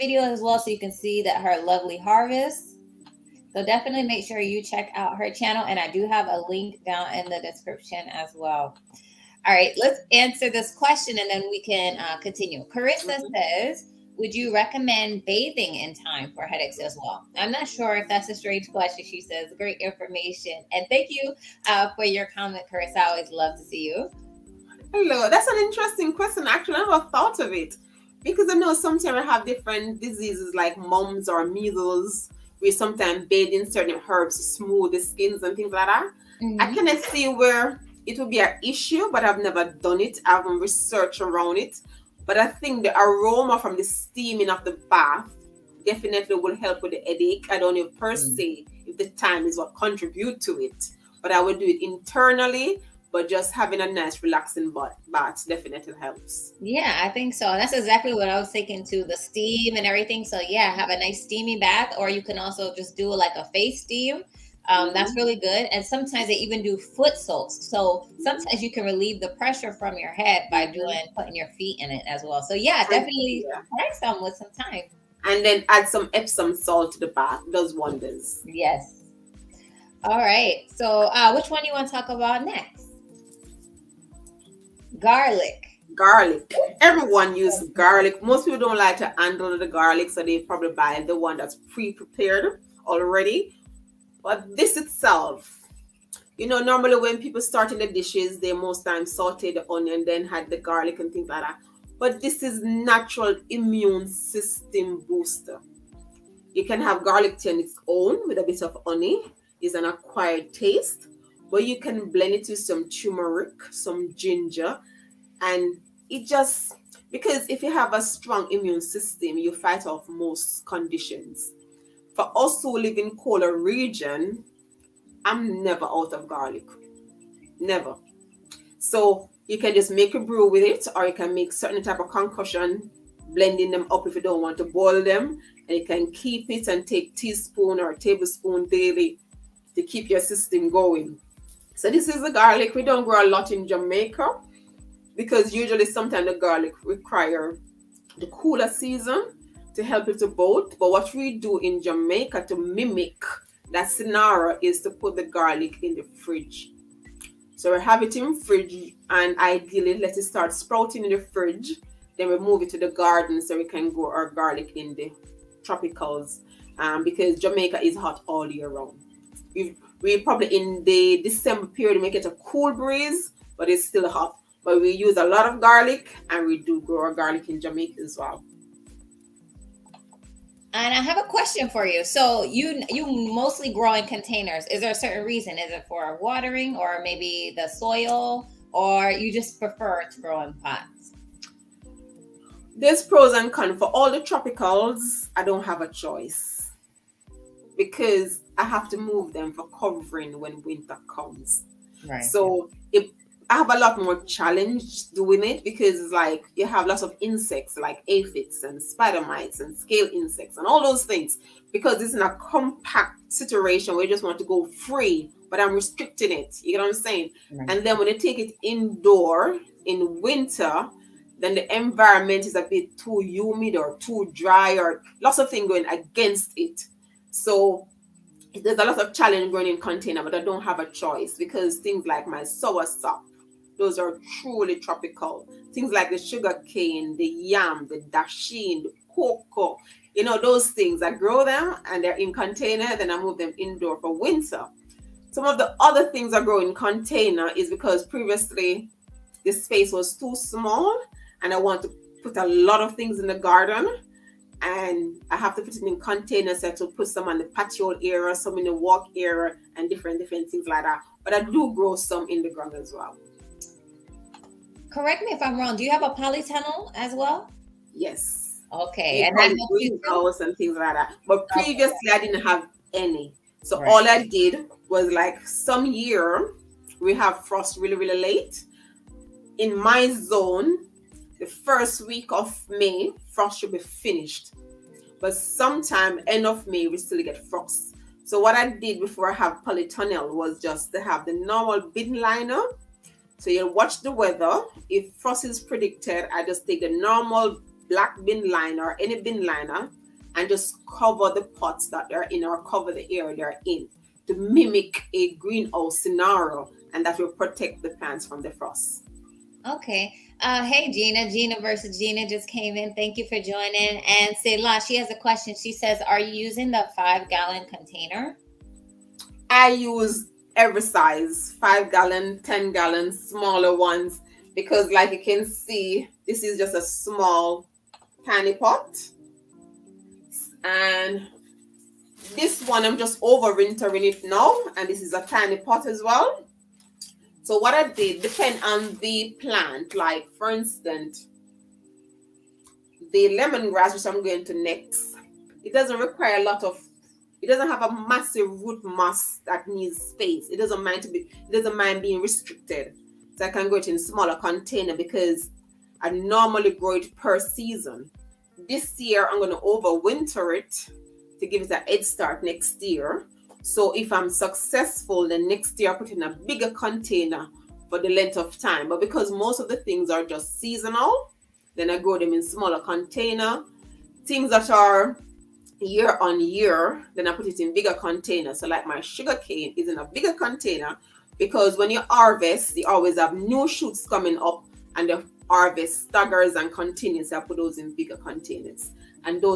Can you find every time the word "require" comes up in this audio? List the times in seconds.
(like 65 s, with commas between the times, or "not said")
146 s, 345 s.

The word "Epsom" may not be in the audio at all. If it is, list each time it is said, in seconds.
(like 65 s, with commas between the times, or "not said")
76 s.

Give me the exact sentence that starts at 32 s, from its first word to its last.
We sometimes bathe in certain herbs to smooth the skins and things like that.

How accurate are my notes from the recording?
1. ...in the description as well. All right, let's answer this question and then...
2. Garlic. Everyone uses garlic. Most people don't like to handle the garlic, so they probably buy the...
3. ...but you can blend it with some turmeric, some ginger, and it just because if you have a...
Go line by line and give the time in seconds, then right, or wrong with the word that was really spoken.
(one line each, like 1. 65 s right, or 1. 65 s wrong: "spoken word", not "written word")
1. 7 s right
2. 85 s right
3. 111 s right.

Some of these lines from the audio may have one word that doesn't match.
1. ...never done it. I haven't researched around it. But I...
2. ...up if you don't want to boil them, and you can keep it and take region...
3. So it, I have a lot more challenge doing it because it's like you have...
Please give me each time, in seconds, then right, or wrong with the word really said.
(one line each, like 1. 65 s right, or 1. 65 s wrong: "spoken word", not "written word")
1. 39 s right
2. 133 s wrong: "teaspoon", not "region"
3. 202 s right.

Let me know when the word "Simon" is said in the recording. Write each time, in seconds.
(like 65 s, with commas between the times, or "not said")
not said.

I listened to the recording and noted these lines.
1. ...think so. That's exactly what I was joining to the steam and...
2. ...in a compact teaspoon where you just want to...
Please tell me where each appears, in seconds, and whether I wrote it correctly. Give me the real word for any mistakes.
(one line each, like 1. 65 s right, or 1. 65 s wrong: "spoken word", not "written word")
1. 57 s wrong: "thinking", not "joining"
2. 212 s wrong: "situation", not "teaspoon".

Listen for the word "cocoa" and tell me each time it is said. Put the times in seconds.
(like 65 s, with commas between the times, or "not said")
239 s.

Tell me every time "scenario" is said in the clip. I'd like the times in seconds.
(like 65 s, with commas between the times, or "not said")
153 s, 305 s.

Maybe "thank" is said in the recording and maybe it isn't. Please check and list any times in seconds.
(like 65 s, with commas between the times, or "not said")
20 s, 312 s.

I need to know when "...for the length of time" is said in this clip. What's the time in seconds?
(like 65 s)
367 s.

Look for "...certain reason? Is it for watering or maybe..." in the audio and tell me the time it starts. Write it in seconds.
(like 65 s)
184 s.